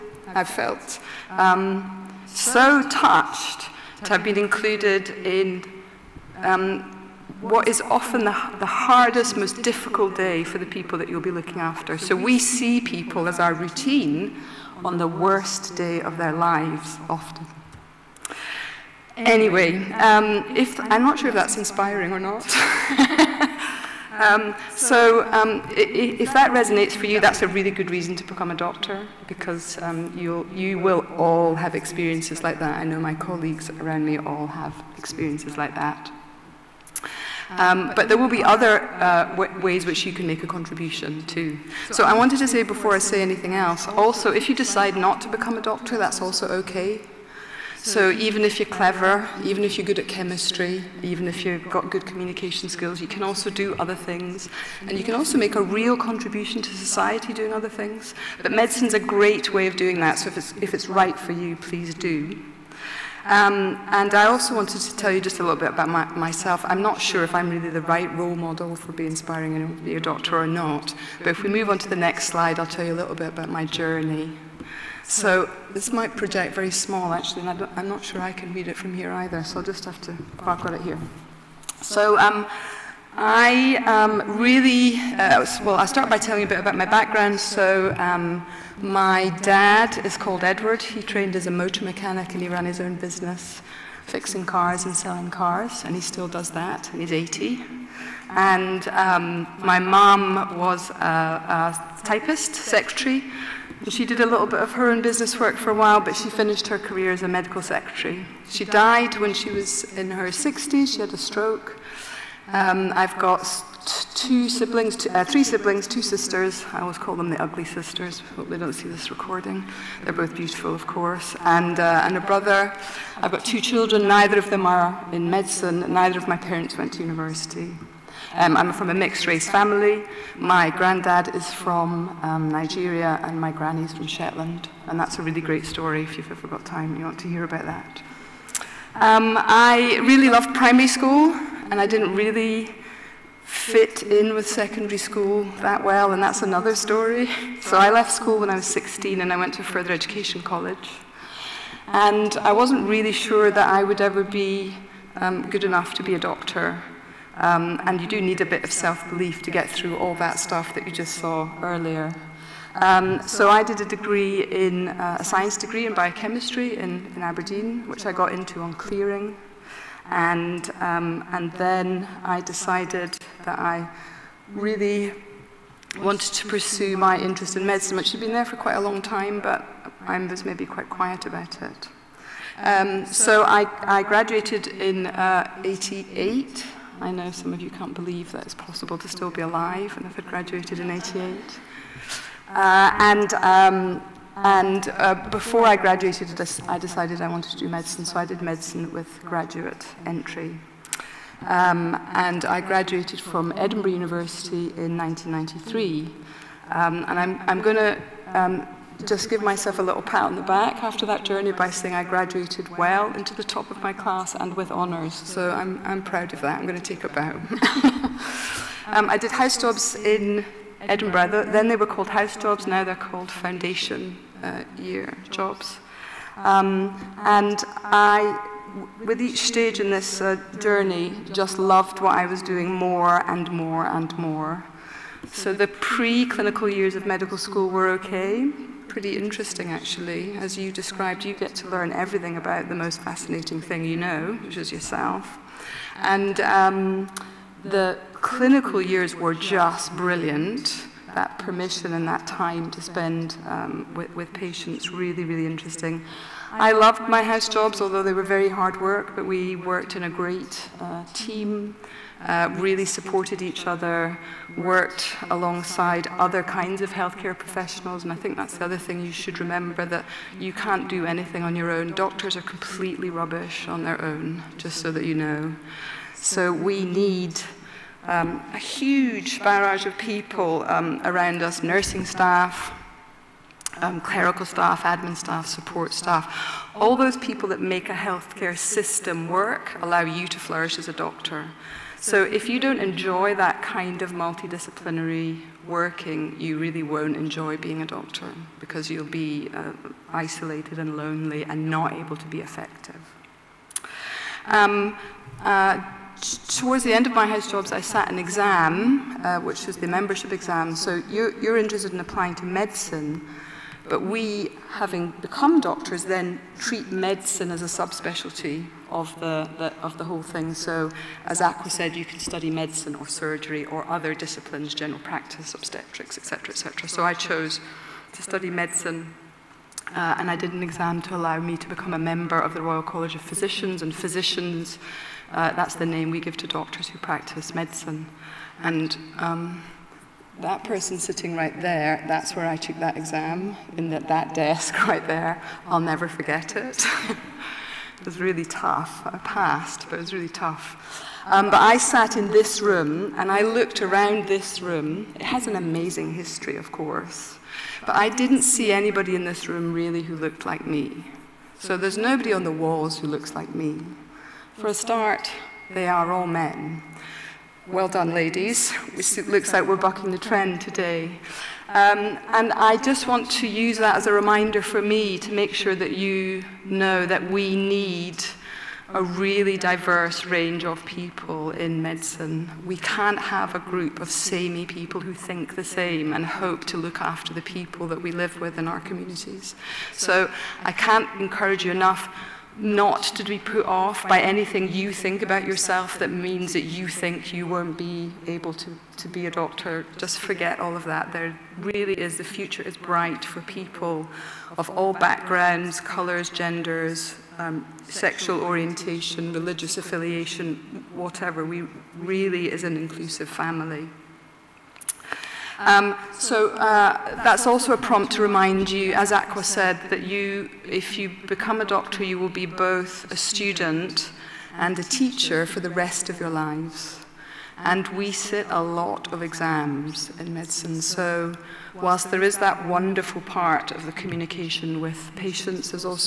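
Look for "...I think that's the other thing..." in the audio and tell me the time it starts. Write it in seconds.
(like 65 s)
268 s.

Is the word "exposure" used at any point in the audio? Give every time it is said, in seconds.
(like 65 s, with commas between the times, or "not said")
not said.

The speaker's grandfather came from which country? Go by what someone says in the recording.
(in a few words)
Nigeria.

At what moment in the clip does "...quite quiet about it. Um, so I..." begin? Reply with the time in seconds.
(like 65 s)
180 s.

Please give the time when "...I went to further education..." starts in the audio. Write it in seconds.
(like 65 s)
149 s.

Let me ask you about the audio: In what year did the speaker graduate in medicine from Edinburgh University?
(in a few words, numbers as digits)
1993.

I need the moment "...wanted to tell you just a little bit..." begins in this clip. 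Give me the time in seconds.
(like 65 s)
64 s.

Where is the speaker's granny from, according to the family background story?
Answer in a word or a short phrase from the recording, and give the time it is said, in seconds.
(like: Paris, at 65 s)
Shetland, at 134 s.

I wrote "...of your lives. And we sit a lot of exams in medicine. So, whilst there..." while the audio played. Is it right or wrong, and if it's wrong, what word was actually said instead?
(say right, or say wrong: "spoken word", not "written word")
right.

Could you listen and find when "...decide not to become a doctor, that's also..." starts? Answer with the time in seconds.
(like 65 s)
44 s.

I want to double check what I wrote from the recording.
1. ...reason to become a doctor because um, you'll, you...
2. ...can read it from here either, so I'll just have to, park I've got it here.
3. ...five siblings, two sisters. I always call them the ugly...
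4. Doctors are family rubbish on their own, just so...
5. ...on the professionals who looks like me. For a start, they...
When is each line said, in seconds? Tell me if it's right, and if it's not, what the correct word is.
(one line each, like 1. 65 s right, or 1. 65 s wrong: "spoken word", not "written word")
1. 27 s right
2. 78 s right
3. 115 s wrong: "three", not "five"
4. 271 s wrong: "completely", not "family"
5. 362 s wrong: "walls", not "professionals".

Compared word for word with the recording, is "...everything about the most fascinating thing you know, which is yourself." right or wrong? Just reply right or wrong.
right.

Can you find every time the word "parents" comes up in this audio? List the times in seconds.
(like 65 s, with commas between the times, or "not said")
126 s.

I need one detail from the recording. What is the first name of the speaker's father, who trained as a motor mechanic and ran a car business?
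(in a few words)
Edward.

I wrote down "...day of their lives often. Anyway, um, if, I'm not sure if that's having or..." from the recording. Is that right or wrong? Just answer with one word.
wrong.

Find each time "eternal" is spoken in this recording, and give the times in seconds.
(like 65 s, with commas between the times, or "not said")
not said.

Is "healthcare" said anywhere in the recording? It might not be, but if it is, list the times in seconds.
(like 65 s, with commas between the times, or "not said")
266 s, 287 s.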